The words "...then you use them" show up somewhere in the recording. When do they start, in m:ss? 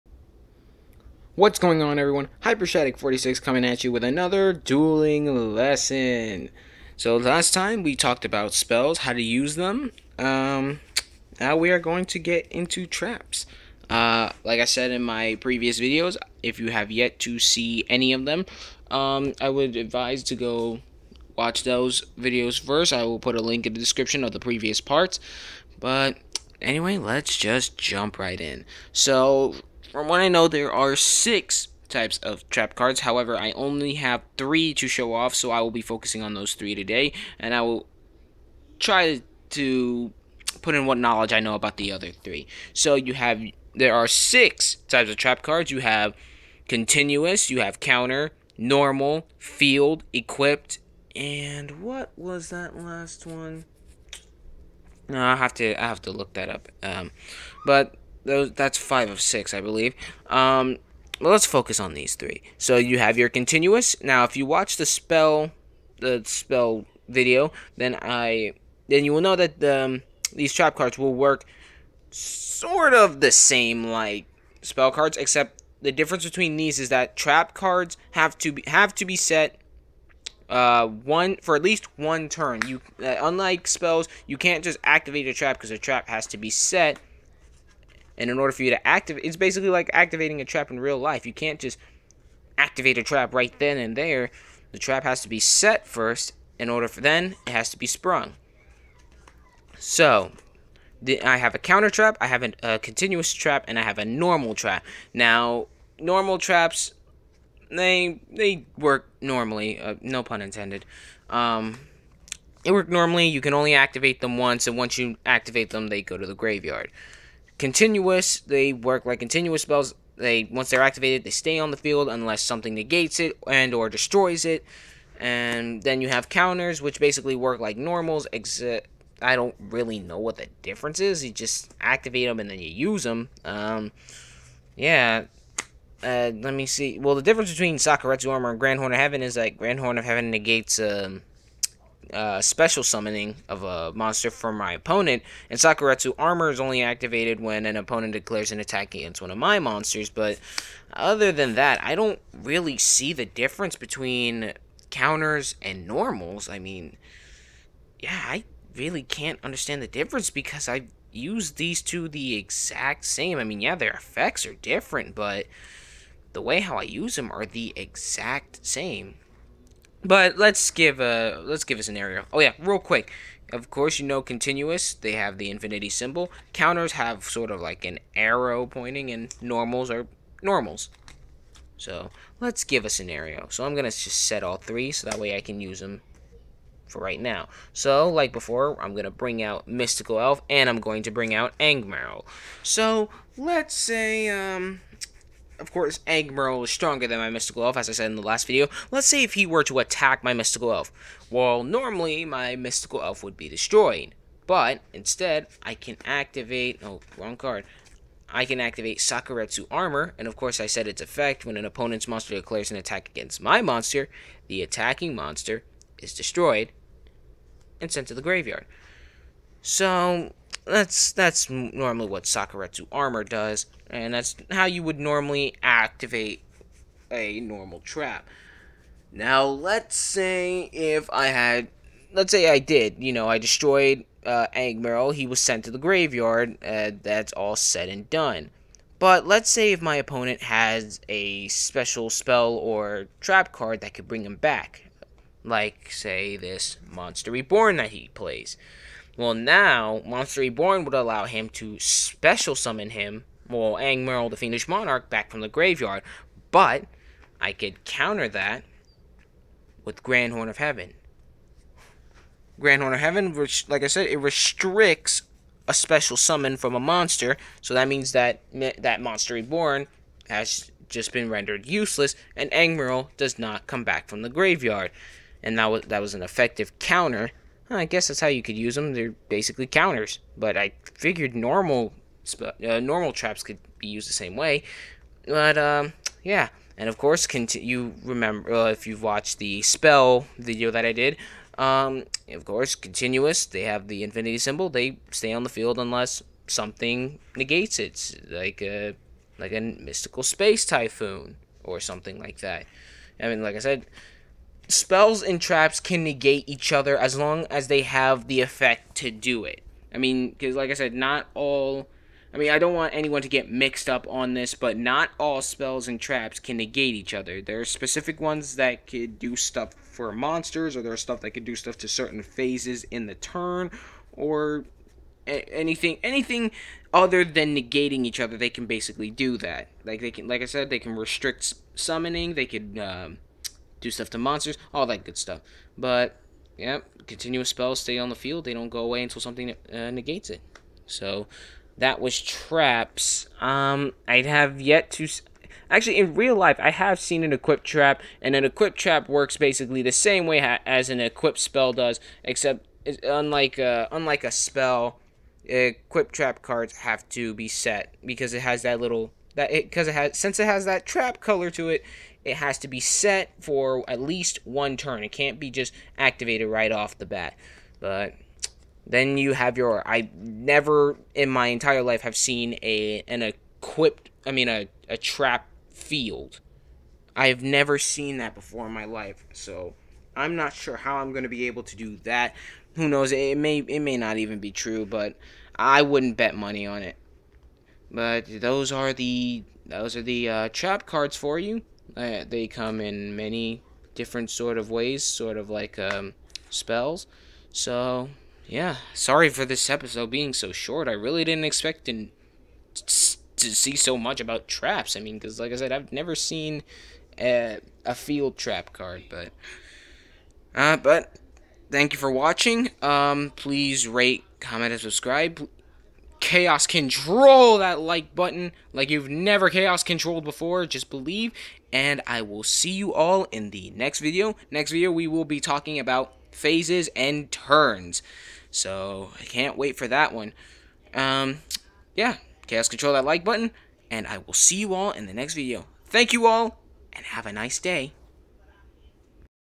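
2:12.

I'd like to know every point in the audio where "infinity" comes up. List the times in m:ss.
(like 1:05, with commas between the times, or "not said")
2:55, 4:54.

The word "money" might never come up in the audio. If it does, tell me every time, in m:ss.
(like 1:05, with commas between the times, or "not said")
6:26.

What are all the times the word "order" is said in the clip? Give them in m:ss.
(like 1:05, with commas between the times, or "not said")
1:28, 1:36.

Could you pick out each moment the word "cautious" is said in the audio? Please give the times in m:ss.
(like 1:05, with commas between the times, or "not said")
not said.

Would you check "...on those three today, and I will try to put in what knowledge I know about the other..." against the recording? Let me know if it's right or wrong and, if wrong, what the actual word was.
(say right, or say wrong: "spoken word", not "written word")
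right.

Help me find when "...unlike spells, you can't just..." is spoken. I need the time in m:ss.
1:23.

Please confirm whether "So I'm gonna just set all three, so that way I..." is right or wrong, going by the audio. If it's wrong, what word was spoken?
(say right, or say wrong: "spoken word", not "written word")
right.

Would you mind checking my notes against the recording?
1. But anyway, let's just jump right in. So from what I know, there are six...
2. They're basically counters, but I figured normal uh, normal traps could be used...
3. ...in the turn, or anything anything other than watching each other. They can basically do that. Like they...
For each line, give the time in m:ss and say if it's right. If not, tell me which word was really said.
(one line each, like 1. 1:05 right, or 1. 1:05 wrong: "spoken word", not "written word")
1. 0:25 right
2. 4:38 right
3. 5:22 wrong: "negating", not "watching".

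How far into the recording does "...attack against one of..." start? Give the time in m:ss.
2:28.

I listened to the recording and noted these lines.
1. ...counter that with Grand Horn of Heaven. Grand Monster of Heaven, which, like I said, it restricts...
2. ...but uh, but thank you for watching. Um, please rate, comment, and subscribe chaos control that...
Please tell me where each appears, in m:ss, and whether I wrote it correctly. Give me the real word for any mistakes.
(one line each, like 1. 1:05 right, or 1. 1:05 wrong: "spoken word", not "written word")
1. 4:17 wrong: "Horn", not "Monster"
2. 6:49 right.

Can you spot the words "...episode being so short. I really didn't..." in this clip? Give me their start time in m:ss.
6:39.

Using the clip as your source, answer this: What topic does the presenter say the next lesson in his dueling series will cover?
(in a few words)
phases and turns.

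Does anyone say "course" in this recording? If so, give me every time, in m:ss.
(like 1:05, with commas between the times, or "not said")
2:53, 3:15, 3:30, 4:46, 4:52.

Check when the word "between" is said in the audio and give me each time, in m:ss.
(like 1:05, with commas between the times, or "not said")
1:16, 2:17, 2:33.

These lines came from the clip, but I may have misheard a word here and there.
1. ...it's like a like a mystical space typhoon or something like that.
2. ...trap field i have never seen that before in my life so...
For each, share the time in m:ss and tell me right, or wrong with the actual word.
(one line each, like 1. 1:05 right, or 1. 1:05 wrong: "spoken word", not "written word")
1. 4:57 right
2. 6:14 right.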